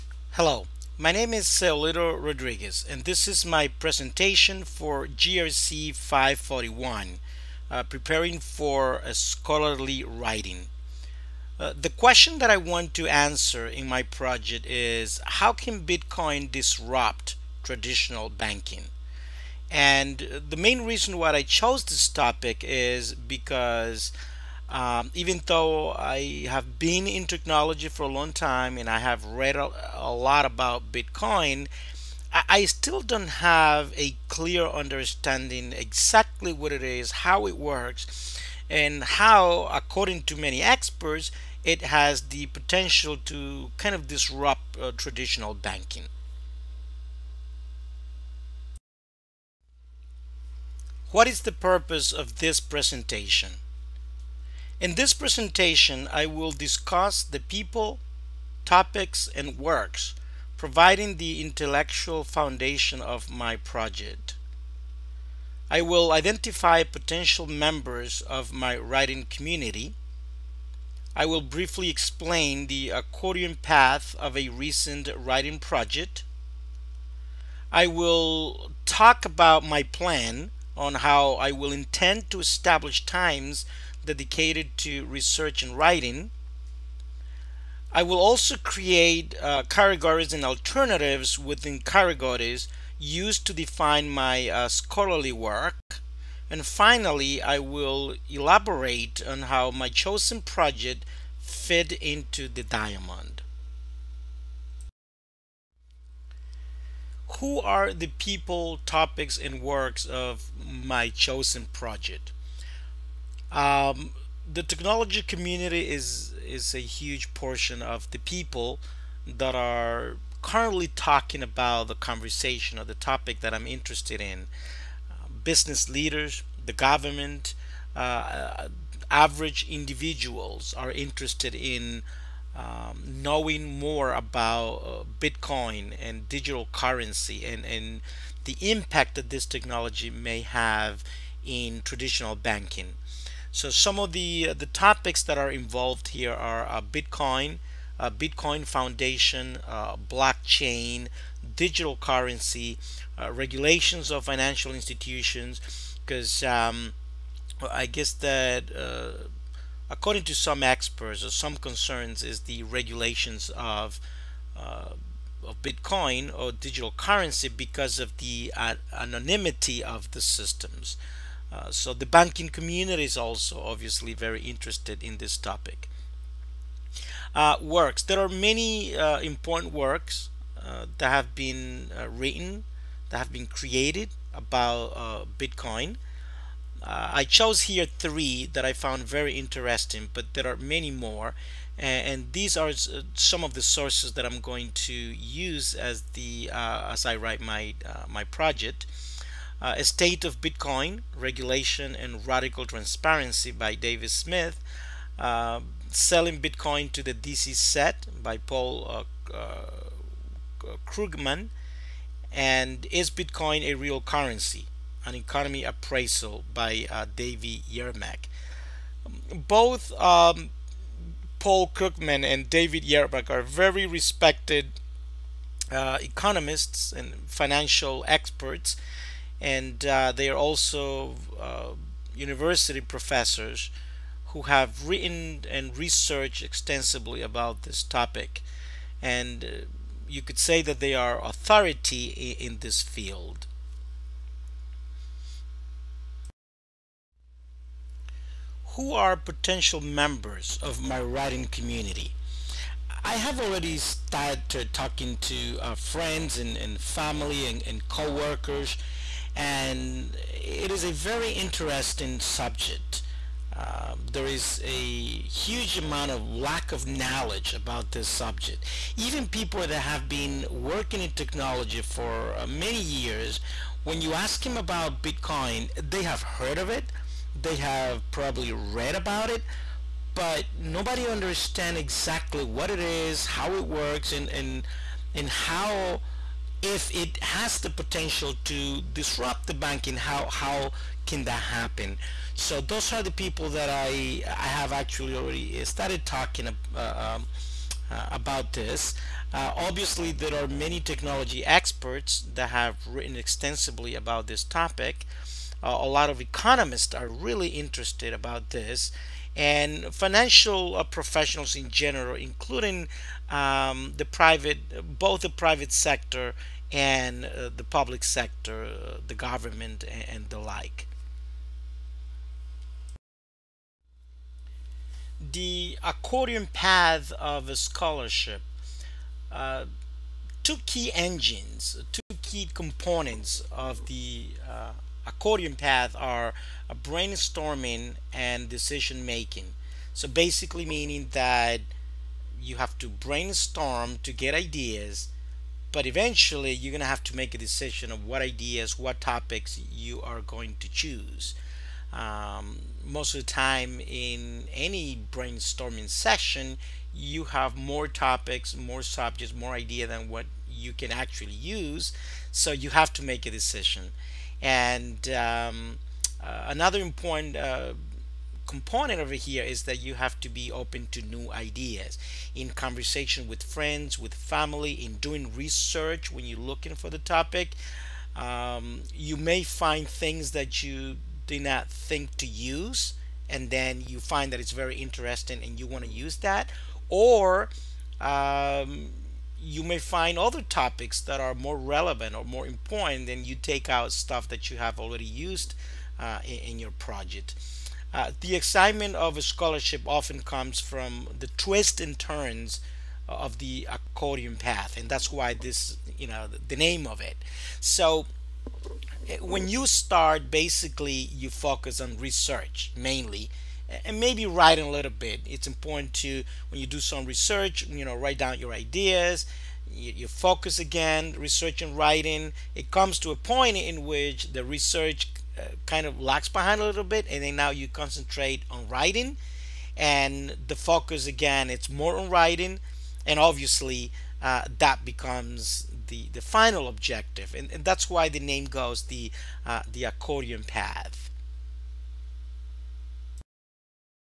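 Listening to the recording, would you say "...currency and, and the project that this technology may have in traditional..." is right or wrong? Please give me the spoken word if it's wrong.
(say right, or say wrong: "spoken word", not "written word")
wrong: "impact", not "project".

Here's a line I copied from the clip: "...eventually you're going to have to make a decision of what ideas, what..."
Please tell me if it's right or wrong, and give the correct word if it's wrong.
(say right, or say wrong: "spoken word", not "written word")
right.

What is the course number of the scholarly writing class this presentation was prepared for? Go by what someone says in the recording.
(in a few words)
GRC 541.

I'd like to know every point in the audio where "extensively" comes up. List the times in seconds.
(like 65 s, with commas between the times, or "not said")
236 s, 303 s.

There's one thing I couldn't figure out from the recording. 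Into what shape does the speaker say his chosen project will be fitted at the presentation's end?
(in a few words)
The diamond.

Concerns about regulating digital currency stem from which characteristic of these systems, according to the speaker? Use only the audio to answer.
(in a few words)
Anonymity.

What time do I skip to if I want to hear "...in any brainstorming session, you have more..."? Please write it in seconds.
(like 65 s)
353 s.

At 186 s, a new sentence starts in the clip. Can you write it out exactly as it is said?
I chose here three that I found very interesting, but there are many more.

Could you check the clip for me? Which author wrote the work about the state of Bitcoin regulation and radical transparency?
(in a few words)
David Smith.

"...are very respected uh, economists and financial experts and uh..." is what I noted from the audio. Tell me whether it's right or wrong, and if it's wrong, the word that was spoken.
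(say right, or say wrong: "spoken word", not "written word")
right.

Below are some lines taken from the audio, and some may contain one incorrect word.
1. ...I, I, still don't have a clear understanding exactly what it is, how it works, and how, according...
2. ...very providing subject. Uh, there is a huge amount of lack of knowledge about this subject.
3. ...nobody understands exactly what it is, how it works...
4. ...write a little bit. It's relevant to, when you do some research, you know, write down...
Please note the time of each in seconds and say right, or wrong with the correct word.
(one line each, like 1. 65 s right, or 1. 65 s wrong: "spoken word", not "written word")
1. 32 s right
2. 260 s wrong: "interesting", not "providing"
3. 280 s right
4. 414 s wrong: "important", not "relevant".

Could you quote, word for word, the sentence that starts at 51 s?
What is the purpose of this presentation?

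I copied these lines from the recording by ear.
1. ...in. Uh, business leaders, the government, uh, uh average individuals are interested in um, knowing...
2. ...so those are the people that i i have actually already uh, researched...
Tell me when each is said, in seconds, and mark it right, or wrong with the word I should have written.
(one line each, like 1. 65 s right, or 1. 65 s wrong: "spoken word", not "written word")
1. 124 s right
2. 292 s wrong: "started", not "researched".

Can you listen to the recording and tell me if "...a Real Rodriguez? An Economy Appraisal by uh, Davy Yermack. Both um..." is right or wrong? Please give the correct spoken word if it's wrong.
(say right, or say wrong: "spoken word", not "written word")
wrong: "Currency", not "Rodriguez".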